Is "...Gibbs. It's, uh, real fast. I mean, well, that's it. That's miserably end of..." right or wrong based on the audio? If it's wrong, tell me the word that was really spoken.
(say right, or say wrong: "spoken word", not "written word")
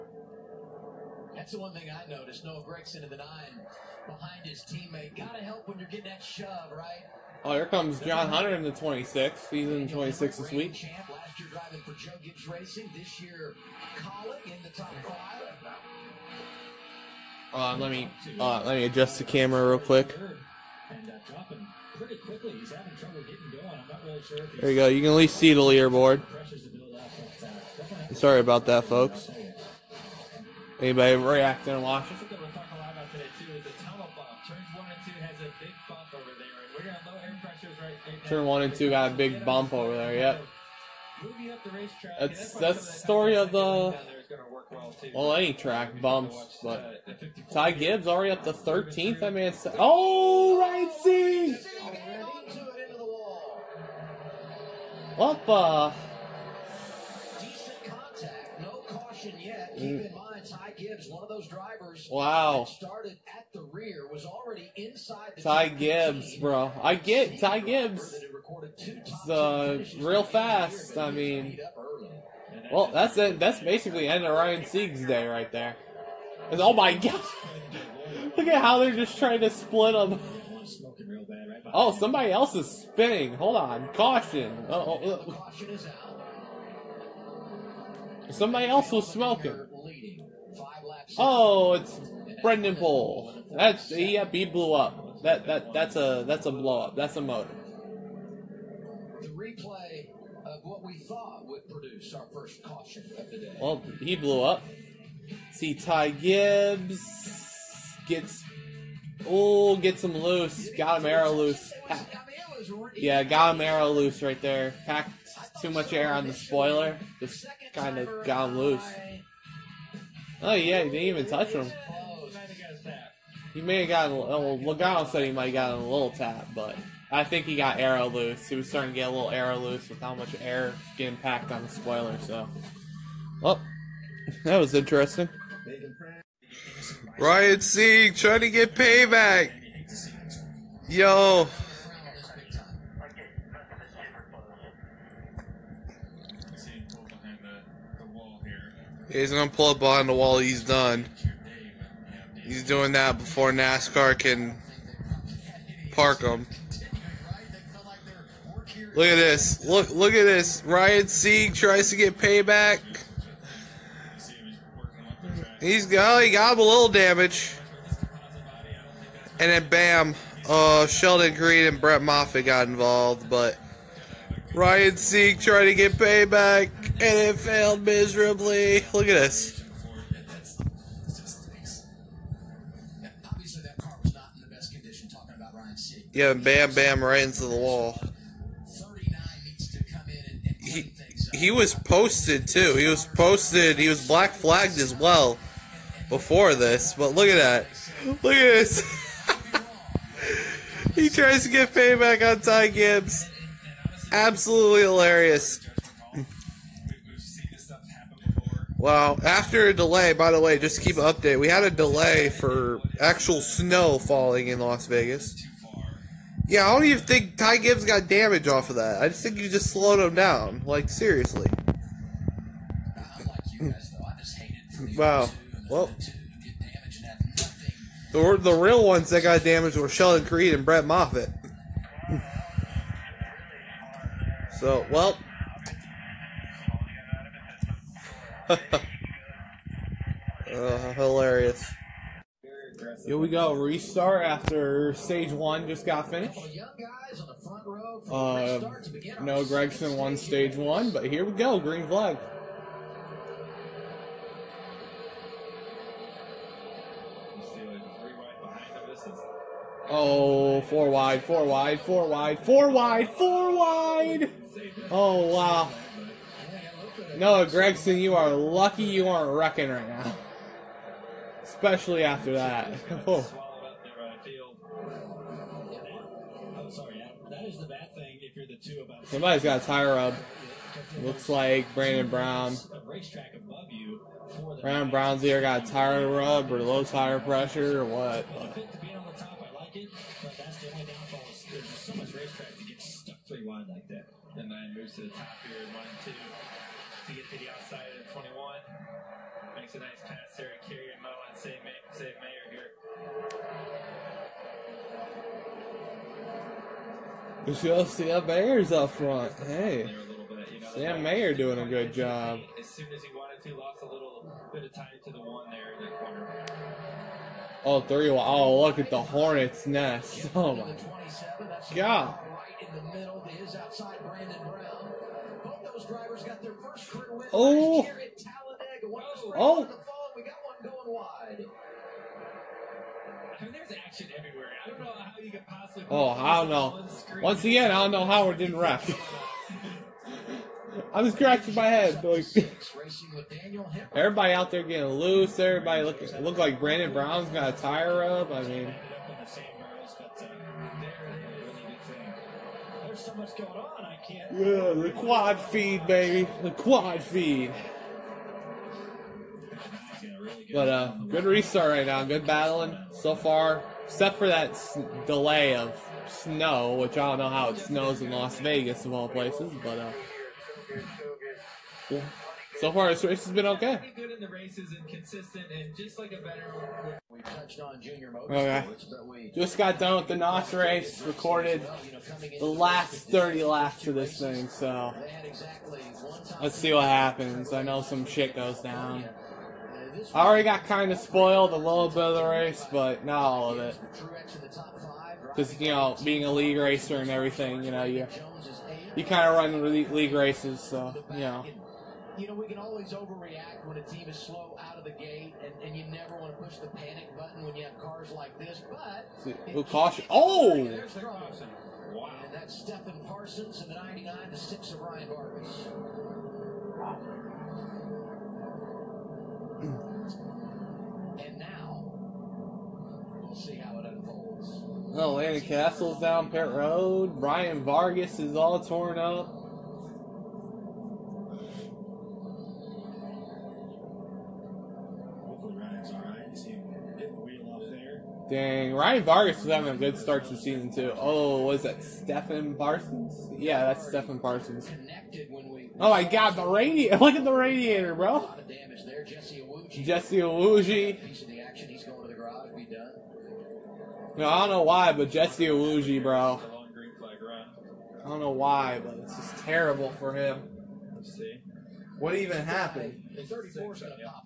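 wrong: "basically", not "miserably".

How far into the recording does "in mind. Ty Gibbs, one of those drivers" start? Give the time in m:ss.
1:00.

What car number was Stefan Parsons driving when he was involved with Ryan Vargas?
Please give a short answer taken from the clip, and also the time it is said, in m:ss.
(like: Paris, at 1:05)
99, at 6:53.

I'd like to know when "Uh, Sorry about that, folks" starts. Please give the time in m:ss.
0:27.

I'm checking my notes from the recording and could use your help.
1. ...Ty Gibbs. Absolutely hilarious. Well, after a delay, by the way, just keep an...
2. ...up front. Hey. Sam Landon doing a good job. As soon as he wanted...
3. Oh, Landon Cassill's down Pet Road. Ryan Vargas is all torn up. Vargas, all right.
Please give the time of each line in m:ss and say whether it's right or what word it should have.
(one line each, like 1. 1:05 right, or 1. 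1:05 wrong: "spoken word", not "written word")
1. 3:22 right
2. 5:08 wrong: "Mayer", not "Landon"
3. 7:04 right.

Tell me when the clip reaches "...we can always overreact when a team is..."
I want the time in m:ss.
6:42.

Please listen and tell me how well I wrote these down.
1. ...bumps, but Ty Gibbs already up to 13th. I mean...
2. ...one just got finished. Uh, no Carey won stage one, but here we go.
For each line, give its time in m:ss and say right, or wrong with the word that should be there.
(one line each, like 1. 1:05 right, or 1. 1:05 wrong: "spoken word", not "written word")
1. 0:46 right
2. 4:05 wrong: "Gragson", not "Carey".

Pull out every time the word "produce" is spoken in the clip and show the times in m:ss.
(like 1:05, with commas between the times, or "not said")
1:41.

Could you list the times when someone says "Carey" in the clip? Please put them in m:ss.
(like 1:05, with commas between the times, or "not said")
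5:00.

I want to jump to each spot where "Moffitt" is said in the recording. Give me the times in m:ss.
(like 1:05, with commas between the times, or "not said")
2:52, 3:50.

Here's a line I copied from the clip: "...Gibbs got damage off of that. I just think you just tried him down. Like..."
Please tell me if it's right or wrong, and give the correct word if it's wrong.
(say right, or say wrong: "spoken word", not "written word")
wrong: "slowed", not "tried".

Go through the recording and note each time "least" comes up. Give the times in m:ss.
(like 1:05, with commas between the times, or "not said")
0:25.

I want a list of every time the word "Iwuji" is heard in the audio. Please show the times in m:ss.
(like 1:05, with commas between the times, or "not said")
7:30, 7:35.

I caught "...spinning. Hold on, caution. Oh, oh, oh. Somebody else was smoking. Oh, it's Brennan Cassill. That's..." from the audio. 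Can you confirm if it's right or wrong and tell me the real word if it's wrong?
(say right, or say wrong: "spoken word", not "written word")
wrong: "Poole", not "Cassill".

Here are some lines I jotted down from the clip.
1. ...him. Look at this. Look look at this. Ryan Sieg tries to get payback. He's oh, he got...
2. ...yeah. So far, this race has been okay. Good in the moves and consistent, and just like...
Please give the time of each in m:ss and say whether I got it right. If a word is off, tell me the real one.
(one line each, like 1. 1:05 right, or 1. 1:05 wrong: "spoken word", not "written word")
1. 2:36 right
2. 6:11 wrong: "races", not "moves".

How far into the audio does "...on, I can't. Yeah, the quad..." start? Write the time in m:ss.
5:53.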